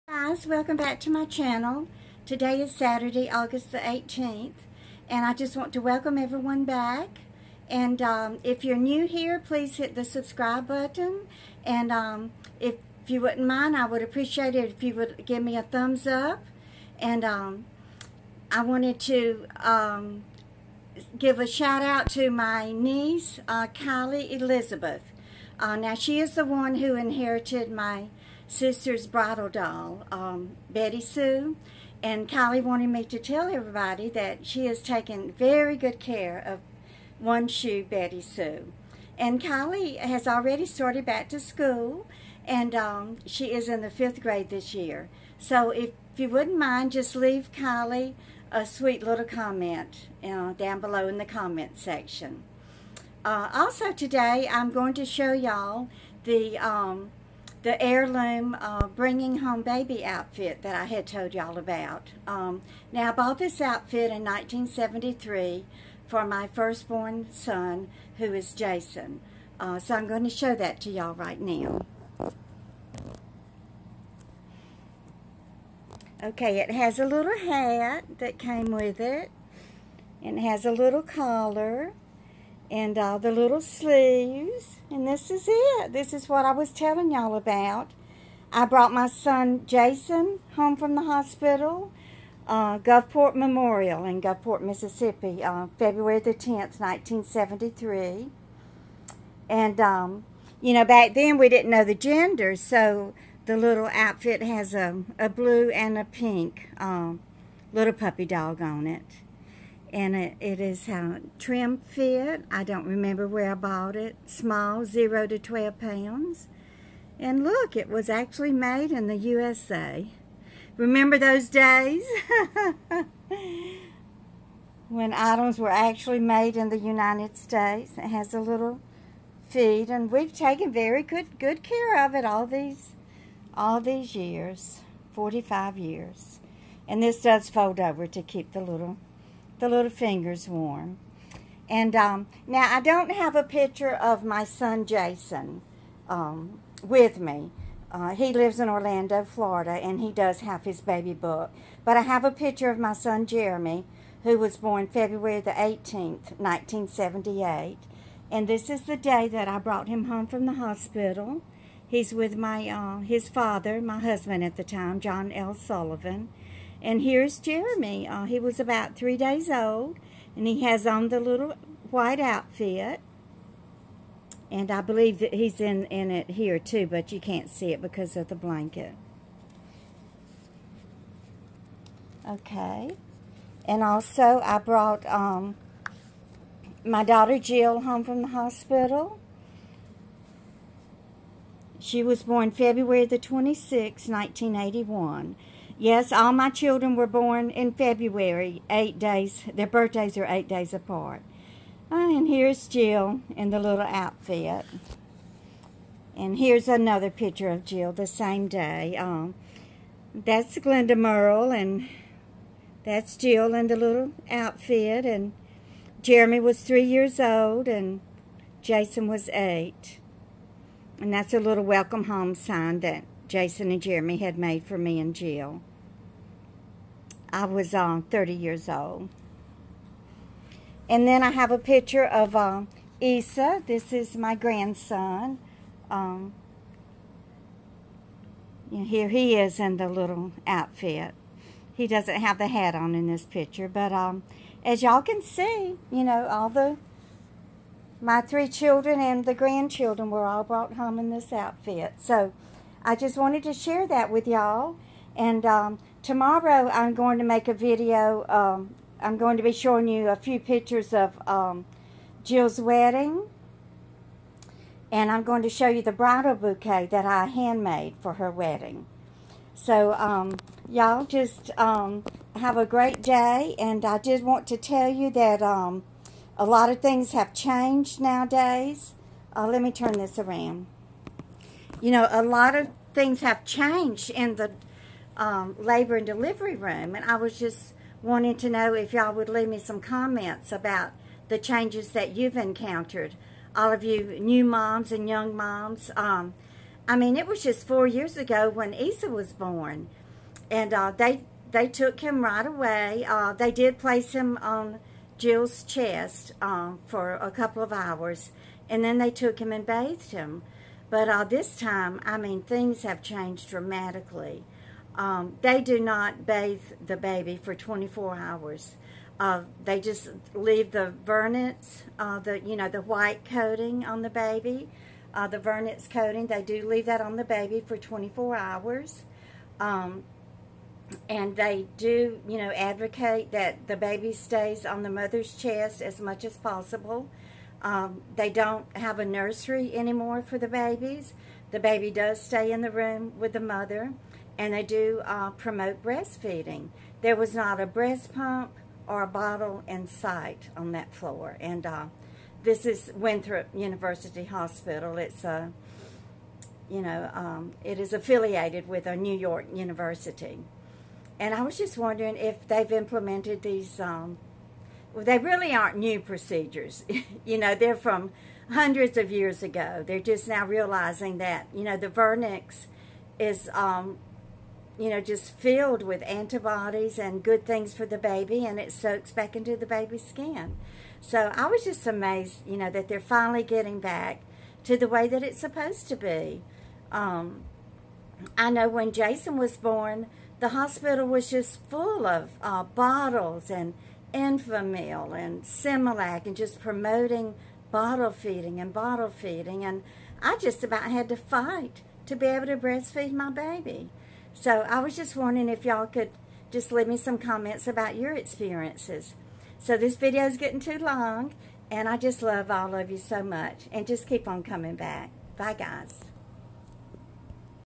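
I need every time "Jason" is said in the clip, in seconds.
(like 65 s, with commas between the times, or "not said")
68 s, 89 s, 144 s, 218 s, 223 s, 388 s.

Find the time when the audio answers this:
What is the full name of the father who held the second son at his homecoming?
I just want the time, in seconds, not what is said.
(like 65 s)
164 s.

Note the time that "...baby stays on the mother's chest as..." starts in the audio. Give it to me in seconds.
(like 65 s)
333 s.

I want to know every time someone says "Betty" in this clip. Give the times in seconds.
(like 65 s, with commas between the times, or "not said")
30 s, 37 s.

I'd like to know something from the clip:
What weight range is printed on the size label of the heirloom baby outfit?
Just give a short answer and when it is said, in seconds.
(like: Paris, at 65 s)
0 to 12 pounds, at 114 s.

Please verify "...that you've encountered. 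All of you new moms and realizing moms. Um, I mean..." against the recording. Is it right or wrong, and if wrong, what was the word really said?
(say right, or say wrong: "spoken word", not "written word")
wrong: "young", not "realizing".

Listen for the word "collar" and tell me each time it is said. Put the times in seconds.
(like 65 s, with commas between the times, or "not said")
81 s.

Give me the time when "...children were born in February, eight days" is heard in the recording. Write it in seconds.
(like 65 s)
196 s.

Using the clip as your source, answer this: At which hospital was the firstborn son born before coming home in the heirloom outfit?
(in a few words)
Gulfport Memorial.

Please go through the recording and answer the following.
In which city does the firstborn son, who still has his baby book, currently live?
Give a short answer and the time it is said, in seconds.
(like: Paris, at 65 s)
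Orlando, at 148 s.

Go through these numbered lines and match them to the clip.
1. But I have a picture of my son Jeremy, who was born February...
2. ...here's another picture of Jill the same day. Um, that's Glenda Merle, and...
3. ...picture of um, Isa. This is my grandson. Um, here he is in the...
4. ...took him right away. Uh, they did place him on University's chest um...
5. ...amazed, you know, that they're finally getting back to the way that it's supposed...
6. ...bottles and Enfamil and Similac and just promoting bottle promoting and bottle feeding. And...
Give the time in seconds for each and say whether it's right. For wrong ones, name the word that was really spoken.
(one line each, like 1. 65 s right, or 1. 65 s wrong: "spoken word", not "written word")
1. 151 s right
2. 206 s right
3. 231 s right
4. 301 s wrong: "Jill", not "University"
5. 381 s right
6. 392 s wrong: "feeding", not "promoting".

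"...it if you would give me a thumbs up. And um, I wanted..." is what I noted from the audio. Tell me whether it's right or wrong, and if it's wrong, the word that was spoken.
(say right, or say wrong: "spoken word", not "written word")
right.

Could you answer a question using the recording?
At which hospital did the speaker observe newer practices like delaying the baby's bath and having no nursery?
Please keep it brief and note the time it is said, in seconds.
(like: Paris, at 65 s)
Winthrop University Hospital, at 352 s.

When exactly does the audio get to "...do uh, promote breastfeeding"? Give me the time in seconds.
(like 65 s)
344 s.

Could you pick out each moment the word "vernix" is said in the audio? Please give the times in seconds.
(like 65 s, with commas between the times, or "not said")
321 s, 325 s, 371 s.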